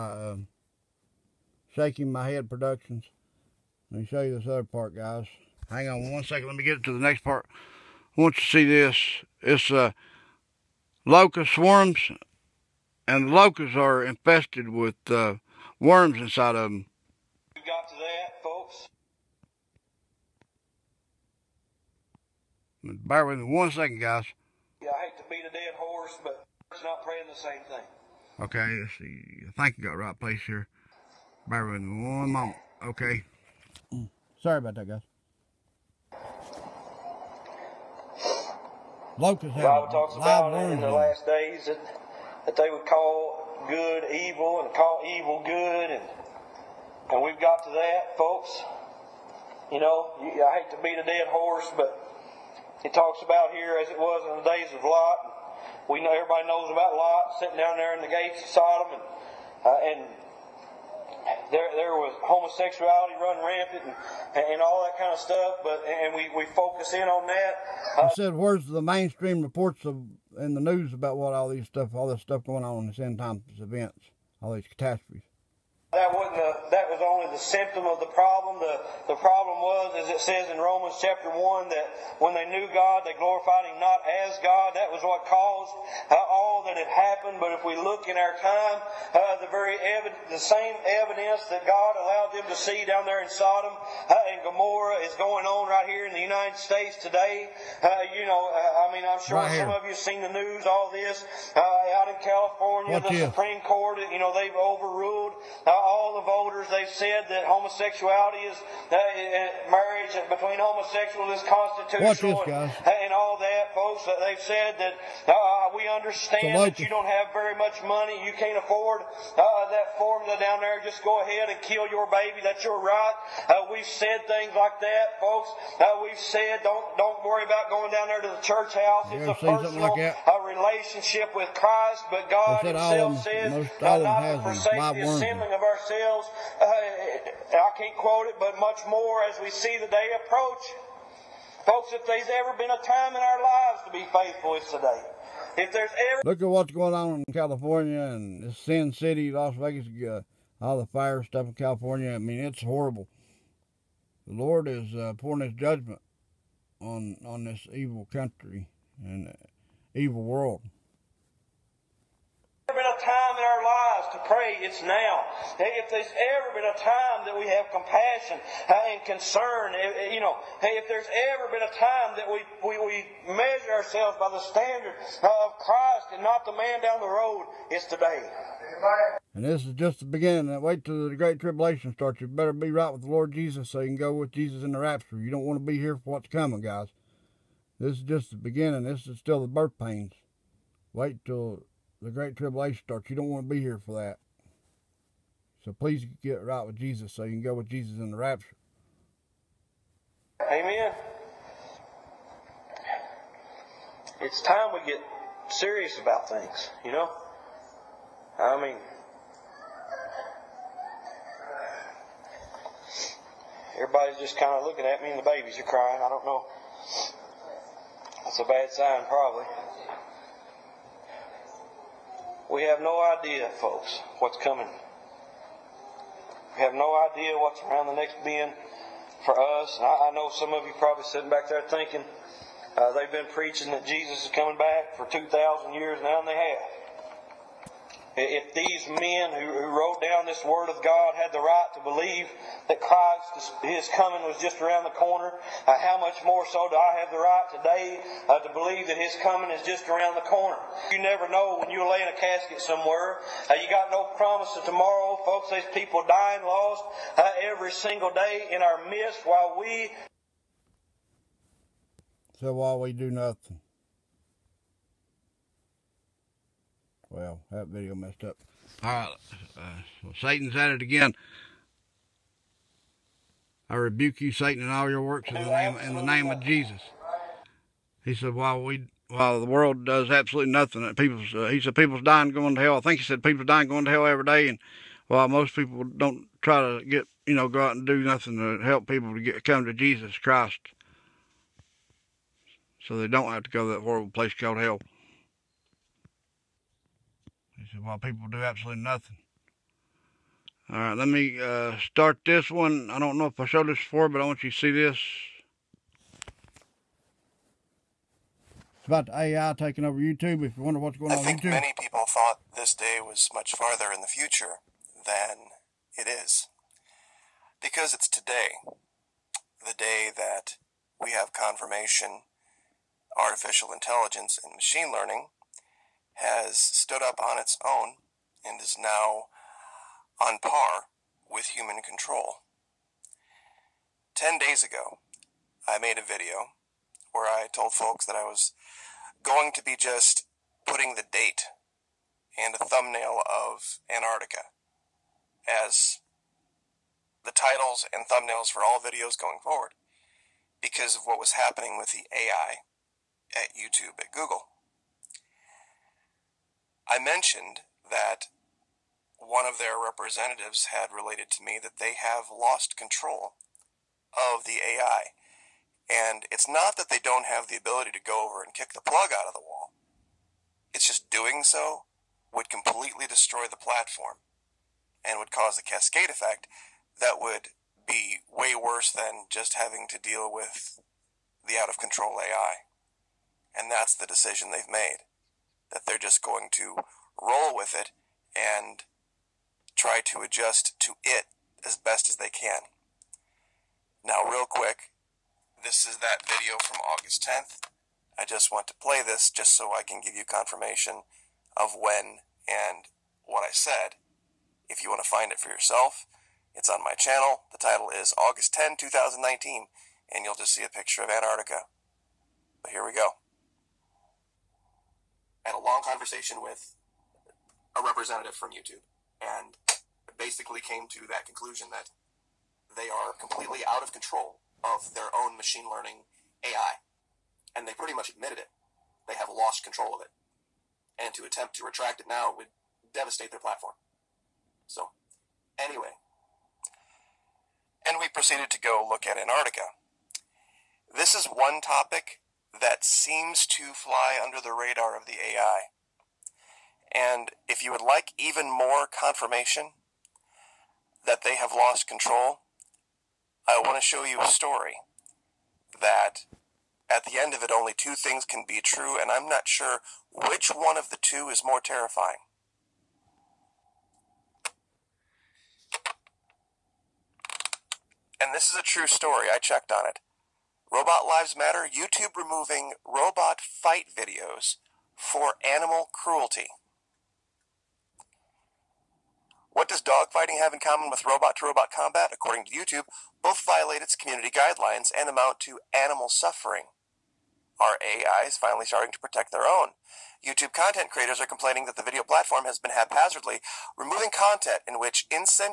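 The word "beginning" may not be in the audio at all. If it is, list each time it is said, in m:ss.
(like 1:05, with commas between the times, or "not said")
3:00, 3:08.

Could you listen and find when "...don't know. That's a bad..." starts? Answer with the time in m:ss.
3:36.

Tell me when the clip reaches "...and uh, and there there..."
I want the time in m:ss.
0:58.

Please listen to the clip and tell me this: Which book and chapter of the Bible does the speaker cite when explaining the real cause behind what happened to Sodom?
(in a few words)
Romans chapter 1.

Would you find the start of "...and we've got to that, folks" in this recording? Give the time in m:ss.
0:47.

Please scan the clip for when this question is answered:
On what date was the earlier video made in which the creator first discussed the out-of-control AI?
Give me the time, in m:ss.
6:48.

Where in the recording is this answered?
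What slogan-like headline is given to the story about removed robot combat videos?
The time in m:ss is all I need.
7:50.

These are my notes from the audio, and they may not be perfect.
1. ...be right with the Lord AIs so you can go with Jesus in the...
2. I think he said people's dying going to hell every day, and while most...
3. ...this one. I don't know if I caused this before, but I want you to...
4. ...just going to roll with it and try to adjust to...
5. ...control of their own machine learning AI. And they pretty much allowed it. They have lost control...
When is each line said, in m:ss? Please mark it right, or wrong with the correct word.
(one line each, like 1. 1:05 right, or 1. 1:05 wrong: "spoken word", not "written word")
1. 3:02 wrong: "Jesus", not "AIs"
2. 4:42 right
3. 5:02 wrong: "showed", not "caused"
4. 6:25 right
5. 7:03 wrong: "admitted", not "allowed".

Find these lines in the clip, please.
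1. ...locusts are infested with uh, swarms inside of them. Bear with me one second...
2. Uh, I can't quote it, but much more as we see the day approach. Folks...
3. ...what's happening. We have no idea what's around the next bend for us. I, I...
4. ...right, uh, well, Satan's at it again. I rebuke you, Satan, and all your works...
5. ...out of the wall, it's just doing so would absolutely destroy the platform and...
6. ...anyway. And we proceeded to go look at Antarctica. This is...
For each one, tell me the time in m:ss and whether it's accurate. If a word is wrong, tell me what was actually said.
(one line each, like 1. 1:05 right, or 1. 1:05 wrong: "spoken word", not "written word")
1. 0:13 wrong: "worms", not "swarms"
2. 2:16 right
3. 3:44 wrong: "coming", not "happening"
4. 4:28 right
5. 6:09 wrong: "completely", not "absolutely"
6. 7:15 right.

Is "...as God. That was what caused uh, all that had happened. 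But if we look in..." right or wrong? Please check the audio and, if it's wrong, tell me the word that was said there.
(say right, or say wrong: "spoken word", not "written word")
right.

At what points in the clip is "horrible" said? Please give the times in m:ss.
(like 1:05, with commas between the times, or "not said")
2:32, 4:53.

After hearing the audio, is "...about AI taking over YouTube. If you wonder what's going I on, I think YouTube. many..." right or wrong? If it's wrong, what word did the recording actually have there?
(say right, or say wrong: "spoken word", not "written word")
right.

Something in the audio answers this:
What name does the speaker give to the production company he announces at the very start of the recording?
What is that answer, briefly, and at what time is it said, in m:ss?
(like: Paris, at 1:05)
Shaking My Head Productions, at 0:01.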